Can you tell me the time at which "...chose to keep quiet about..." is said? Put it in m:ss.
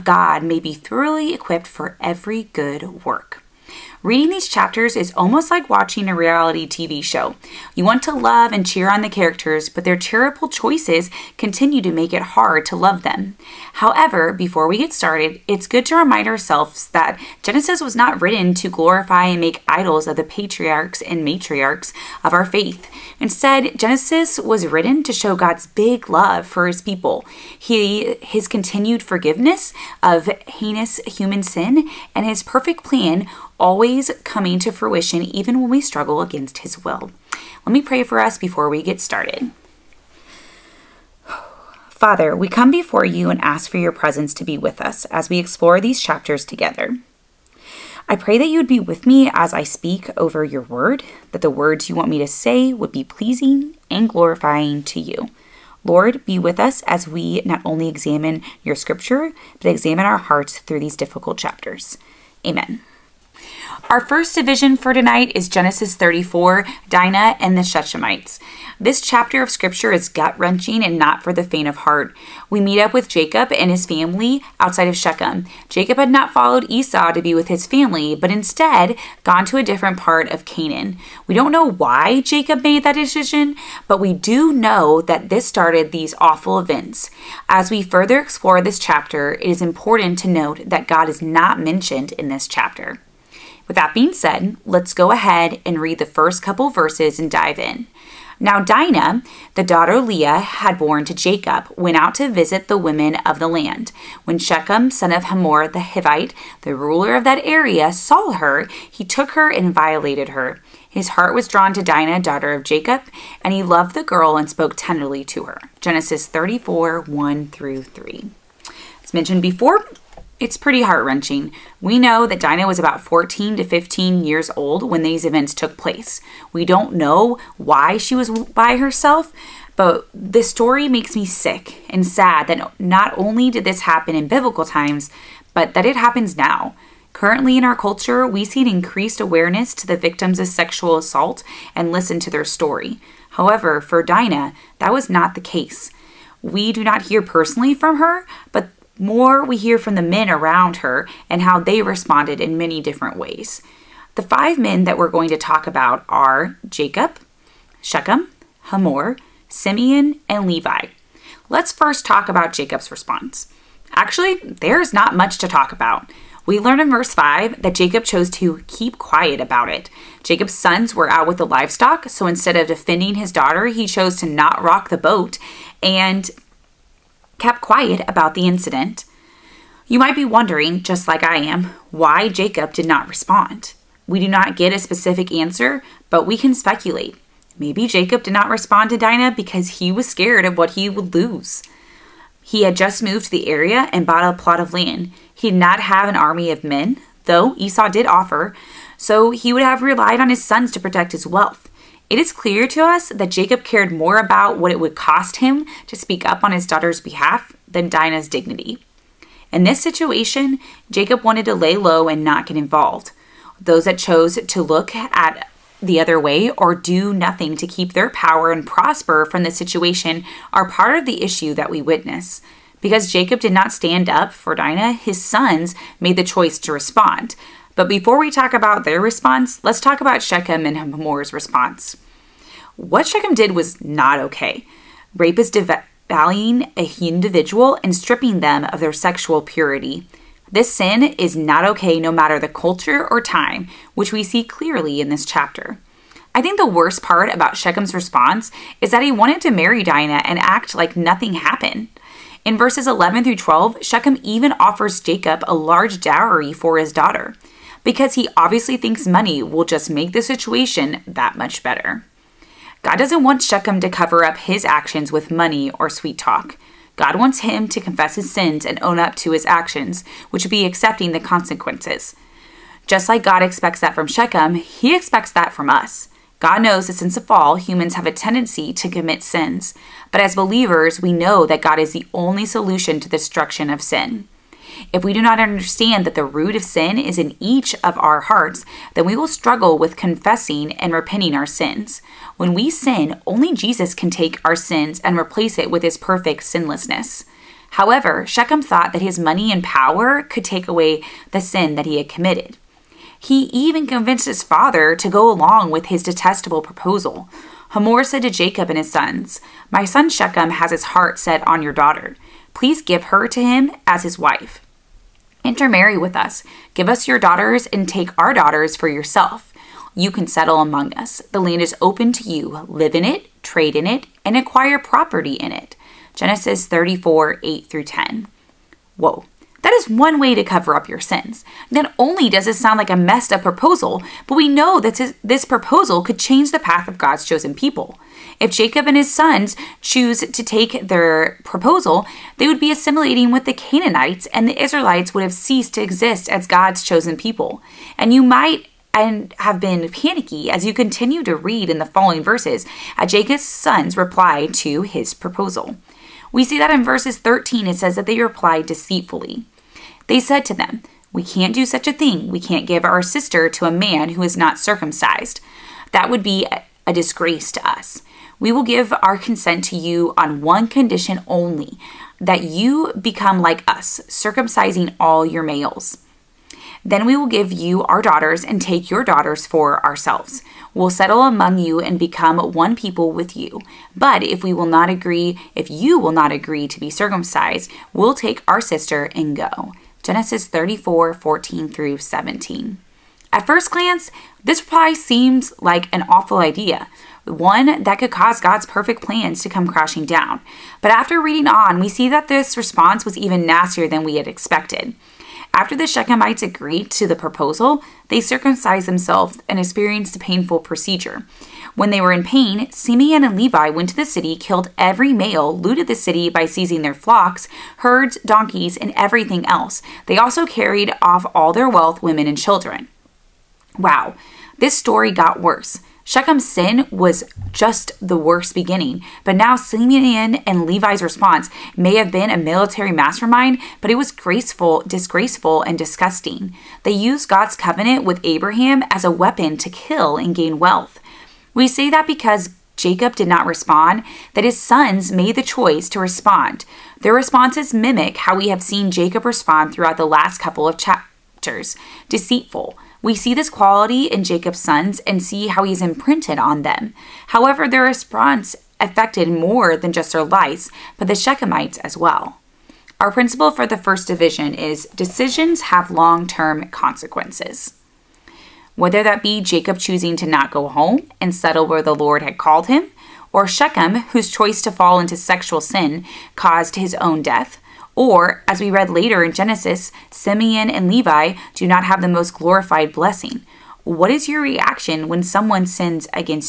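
2:48.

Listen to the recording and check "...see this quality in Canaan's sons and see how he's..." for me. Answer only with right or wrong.
wrong.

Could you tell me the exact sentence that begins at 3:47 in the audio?
But before we talk about their response, let's talk about Shechem and Hamor's response.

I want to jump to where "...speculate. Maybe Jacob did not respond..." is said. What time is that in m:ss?
3:06.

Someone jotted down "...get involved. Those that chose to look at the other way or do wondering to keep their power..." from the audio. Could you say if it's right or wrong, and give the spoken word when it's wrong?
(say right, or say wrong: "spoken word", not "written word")
wrong: "nothing", not "wondering".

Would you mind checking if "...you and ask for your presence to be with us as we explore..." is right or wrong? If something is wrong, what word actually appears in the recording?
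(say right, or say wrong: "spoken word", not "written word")
right.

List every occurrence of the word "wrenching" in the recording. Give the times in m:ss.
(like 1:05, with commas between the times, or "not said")
1:10, 2:01.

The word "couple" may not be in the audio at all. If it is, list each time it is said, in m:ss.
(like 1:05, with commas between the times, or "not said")
1:36, 7:30.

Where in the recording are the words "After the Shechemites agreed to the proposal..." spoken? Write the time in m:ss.
6:45.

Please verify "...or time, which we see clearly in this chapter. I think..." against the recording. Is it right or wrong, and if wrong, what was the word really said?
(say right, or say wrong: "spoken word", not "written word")
right.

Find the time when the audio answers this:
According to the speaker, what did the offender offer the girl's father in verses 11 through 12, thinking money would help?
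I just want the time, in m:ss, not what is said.
4:15.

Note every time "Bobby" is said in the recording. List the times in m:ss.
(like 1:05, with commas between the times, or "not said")
not said.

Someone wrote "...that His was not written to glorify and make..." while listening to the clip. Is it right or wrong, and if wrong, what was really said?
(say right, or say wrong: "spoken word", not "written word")
wrong: "Genesis", not "His".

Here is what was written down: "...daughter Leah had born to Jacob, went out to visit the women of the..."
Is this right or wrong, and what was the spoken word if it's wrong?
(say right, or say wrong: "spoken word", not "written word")
right.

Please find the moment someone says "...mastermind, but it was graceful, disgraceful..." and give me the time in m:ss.
7:12.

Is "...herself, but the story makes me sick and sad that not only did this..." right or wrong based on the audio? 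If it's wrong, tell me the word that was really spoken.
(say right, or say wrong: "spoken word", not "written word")
right.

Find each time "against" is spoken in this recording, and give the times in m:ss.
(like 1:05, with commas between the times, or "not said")
0:36.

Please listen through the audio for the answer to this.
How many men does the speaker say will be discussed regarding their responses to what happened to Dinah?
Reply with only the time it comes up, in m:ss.
2:34.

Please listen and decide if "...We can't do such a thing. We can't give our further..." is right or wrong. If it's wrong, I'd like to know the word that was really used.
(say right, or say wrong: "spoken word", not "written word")
wrong: "sister", not "further".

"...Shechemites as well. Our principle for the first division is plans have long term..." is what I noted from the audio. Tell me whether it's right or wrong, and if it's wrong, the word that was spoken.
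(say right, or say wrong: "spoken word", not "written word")
wrong: "decisions", not "plans".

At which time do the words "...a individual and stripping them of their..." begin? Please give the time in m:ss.
3:56.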